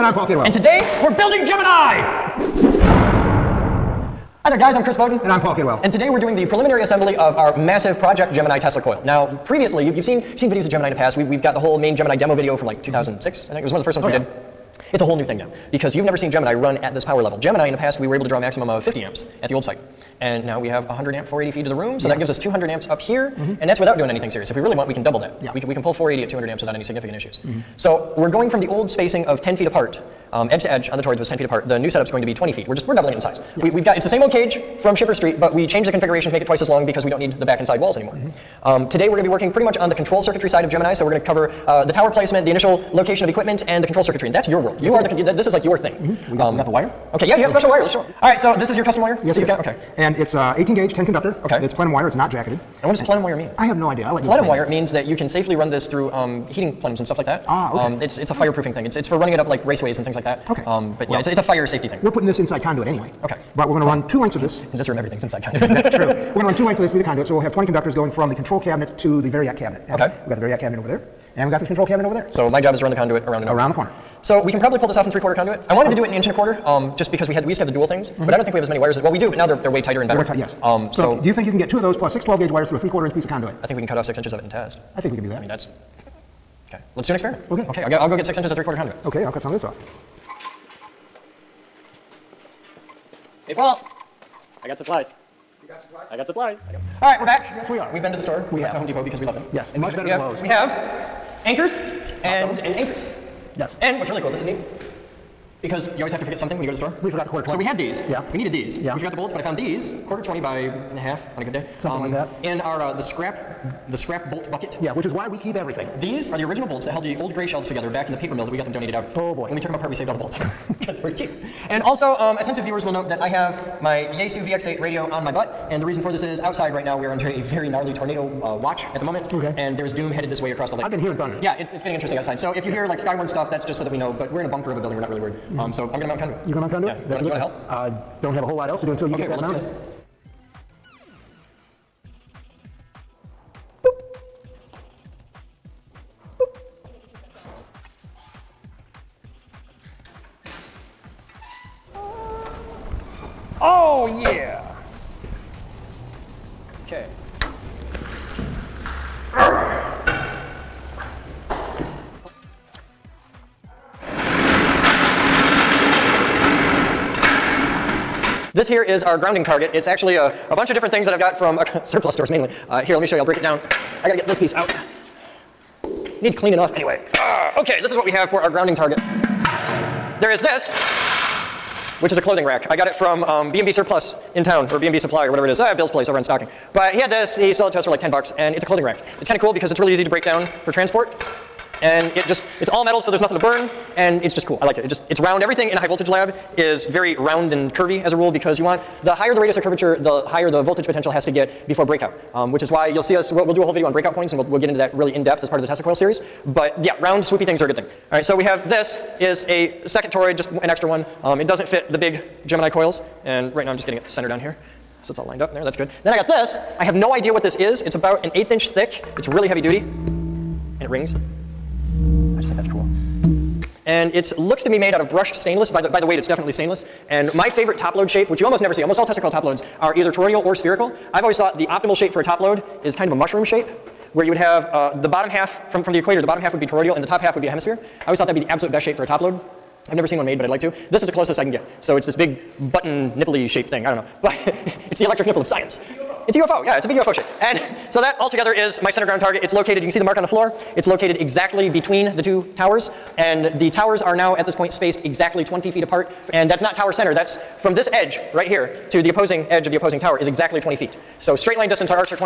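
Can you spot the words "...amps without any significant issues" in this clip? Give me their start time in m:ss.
0:26.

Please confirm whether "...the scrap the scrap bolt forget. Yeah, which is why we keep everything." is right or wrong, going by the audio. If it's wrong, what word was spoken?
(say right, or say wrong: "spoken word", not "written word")
wrong: "bucket", not "forget".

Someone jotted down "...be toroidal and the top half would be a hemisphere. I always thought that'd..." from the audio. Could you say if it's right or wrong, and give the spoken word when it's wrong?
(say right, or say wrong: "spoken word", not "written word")
right.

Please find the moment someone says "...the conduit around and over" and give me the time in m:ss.
1:12.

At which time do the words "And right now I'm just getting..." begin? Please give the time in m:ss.
3:33.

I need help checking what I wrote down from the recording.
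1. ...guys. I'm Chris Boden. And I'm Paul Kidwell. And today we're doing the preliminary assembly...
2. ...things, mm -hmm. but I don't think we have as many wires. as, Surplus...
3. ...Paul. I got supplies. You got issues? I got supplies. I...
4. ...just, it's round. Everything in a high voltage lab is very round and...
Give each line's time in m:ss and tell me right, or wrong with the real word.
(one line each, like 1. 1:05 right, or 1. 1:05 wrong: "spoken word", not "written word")
1. 0:04 right
2. 1:17 wrong: "Well", not "Surplus"
3. 1:33 wrong: "supplies", not "issues"
4. 3:14 right.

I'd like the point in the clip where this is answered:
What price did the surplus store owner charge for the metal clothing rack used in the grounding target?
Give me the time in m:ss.
3:07.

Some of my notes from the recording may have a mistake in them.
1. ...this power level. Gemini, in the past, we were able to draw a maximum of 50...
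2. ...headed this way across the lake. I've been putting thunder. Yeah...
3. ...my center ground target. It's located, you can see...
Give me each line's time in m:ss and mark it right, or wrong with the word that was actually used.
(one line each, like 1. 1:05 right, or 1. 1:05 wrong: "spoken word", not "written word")
1. 0:16 right
2. 2:10 wrong: "hearing", not "putting"
3. 4:08 right.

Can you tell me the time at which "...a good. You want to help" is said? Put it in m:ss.
2:17.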